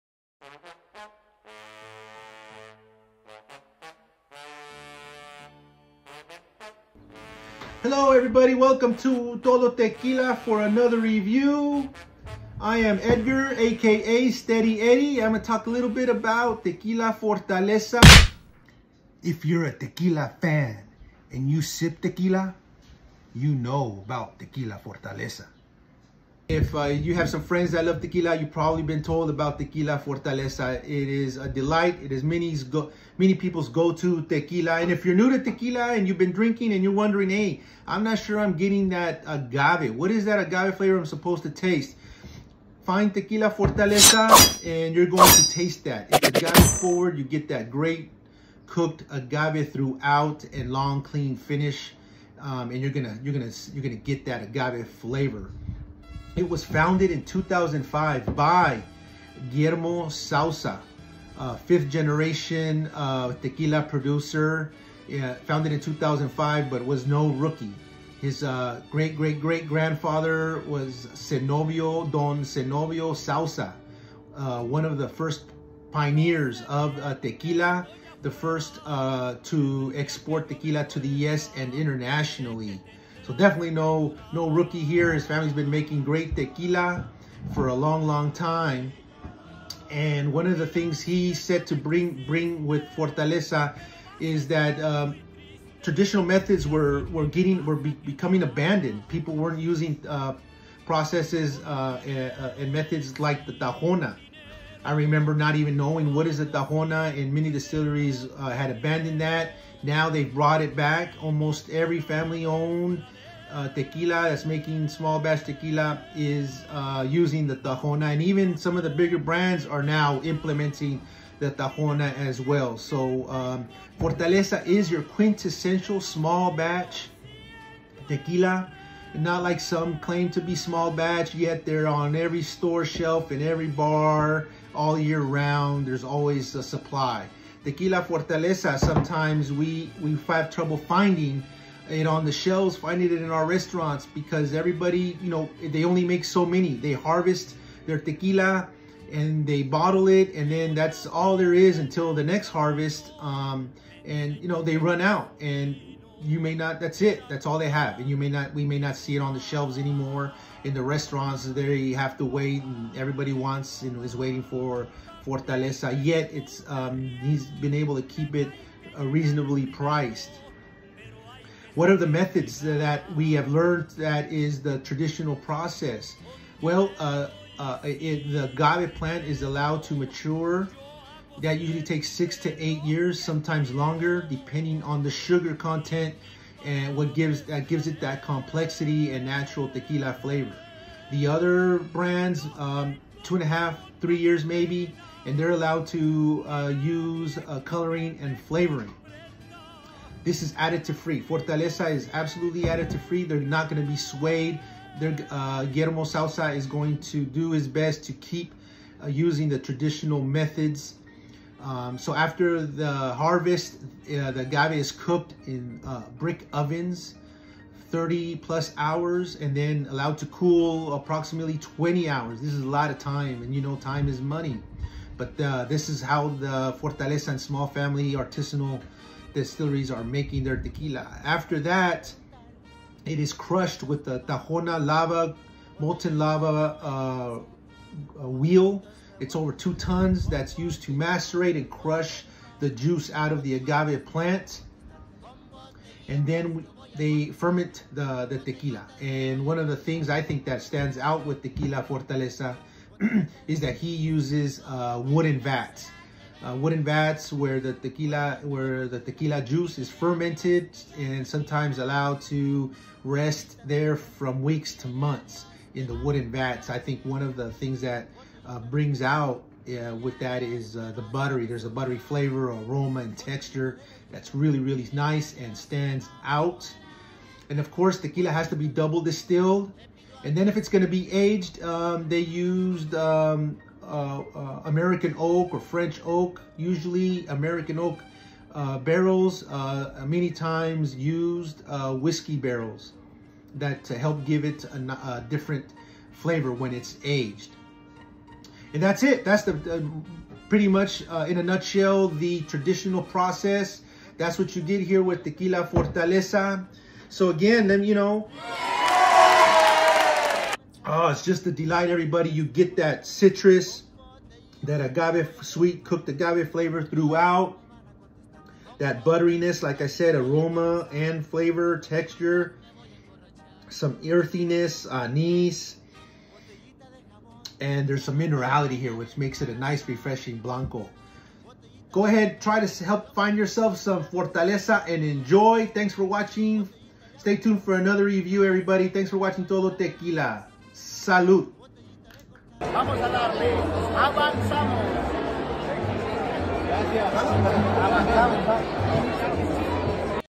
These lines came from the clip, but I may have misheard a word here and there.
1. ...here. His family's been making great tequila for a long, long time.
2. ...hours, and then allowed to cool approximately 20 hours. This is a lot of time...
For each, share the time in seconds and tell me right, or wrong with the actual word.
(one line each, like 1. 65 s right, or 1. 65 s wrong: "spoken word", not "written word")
1. 84 s right
2. 218 s right.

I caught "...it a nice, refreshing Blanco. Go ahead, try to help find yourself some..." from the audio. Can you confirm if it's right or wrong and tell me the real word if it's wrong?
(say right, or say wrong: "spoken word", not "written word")
right.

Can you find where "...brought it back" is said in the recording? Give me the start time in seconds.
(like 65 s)
110 s.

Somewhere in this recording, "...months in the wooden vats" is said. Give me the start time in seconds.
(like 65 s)
264 s.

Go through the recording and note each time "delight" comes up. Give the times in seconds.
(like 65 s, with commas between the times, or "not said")
31 s, 311 s.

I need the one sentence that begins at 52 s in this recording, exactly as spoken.
Um, and you're gonna you're gonna you're gonna get that agave flavor.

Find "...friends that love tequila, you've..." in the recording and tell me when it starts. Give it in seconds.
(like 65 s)
27 s.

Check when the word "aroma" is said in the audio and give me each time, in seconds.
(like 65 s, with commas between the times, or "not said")
272 s, 320 s.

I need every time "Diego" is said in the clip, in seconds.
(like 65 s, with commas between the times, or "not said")
not said.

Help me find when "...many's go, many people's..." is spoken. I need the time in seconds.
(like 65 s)
32 s.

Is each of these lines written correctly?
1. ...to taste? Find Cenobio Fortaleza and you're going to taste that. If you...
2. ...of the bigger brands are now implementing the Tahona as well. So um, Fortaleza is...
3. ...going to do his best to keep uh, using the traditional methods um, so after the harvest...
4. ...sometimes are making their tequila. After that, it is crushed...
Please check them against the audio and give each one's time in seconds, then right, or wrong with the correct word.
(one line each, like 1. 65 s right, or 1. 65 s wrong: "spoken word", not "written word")
1. 41 s wrong: "Tequila", not "Cenobio"
2. 118 s right
3. 206 s right
4. 229 s wrong: "distilleries", not "sometimes".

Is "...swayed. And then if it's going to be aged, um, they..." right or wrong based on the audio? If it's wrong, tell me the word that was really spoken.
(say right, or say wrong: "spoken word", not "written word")
wrong: "distilled", not "swayed".